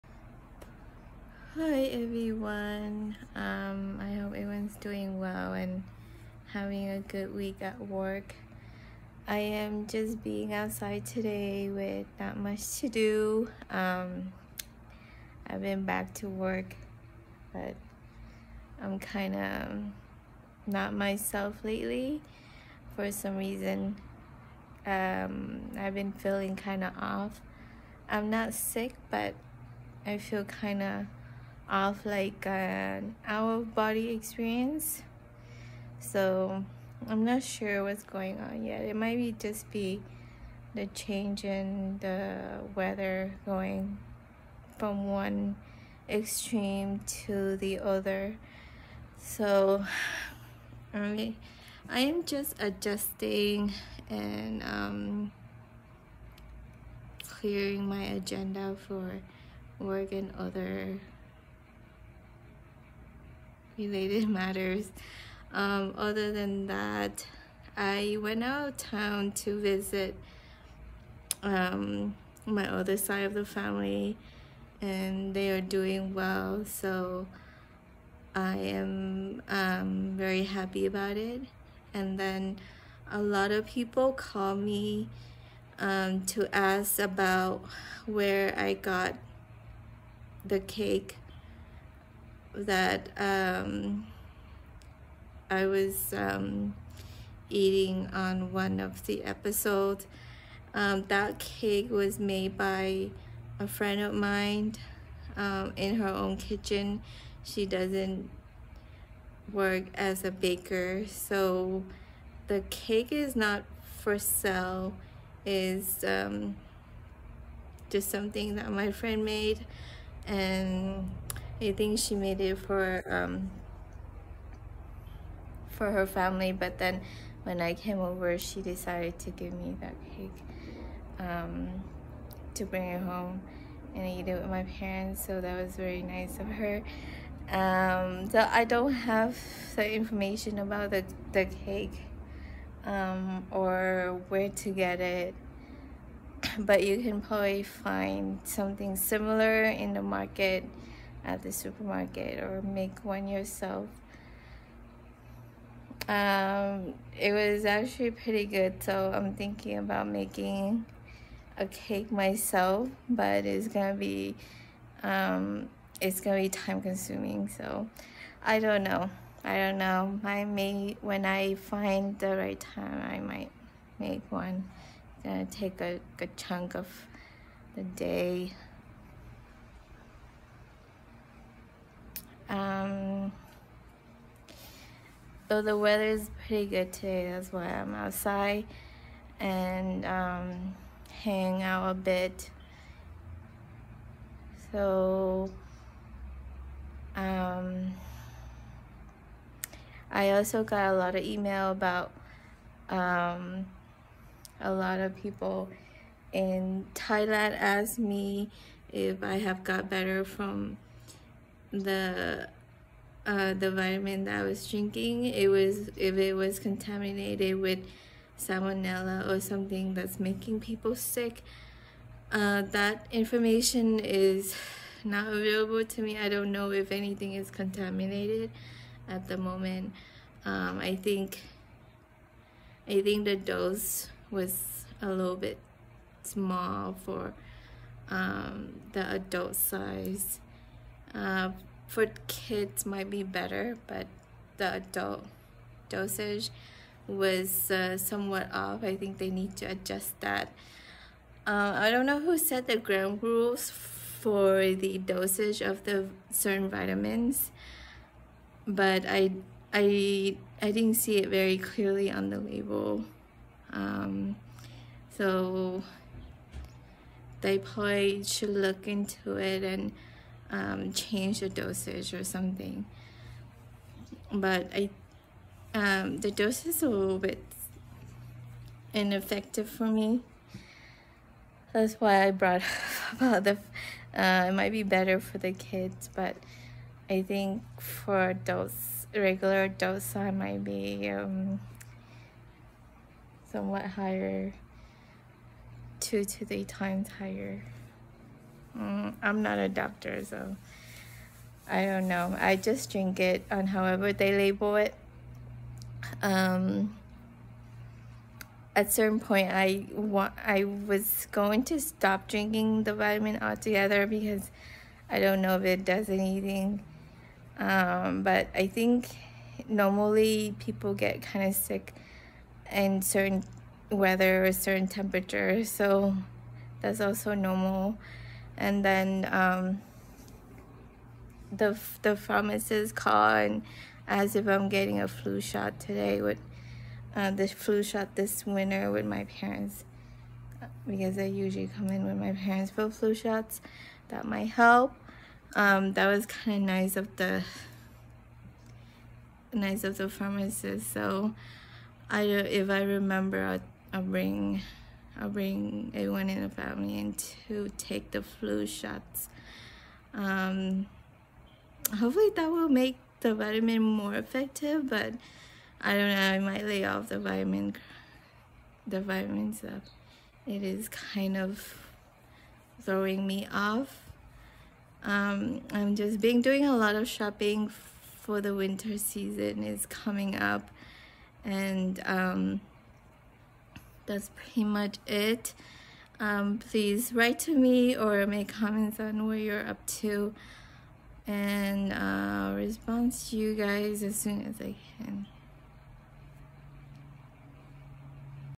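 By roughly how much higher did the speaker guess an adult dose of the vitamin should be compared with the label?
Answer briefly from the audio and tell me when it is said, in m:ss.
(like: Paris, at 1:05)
2 to 3 times, at 4:56.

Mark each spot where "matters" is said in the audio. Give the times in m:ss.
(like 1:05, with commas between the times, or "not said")
1:04.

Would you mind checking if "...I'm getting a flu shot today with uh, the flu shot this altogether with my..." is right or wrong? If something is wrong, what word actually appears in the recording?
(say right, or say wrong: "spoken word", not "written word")
wrong: "winter", not "altogether".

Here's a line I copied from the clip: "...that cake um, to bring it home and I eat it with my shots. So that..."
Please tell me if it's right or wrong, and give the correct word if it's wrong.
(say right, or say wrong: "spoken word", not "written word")
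wrong: "parents", not "shots".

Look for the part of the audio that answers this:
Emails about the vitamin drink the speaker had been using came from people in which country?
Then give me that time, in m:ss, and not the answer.
3:26.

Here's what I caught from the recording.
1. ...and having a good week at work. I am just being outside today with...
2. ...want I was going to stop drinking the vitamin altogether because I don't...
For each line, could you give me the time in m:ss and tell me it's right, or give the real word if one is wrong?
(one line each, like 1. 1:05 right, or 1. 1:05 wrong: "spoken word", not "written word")
1. 0:05 right
2. 5:09 right.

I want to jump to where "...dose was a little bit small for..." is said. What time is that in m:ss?
3:53.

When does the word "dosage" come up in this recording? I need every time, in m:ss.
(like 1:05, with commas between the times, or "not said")
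4:05, 4:14, 4:31.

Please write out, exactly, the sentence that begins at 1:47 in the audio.
She doesn't work as a baker, so the cake is not for sale.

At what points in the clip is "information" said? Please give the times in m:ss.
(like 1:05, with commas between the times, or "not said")
2:19, 3:43.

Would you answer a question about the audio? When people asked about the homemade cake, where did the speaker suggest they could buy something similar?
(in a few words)
supermarket.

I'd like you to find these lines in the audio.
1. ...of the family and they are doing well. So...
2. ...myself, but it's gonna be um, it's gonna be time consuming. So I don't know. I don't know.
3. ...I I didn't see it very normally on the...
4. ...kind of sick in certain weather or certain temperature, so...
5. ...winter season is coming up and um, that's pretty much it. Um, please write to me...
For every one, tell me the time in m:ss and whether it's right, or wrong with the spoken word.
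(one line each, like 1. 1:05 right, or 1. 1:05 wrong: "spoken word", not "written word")
1. 1:13 right
2. 2:42 right
3. 4:19 wrong: "clearly", not "normally"
4. 5:21 right
5. 6:18 right.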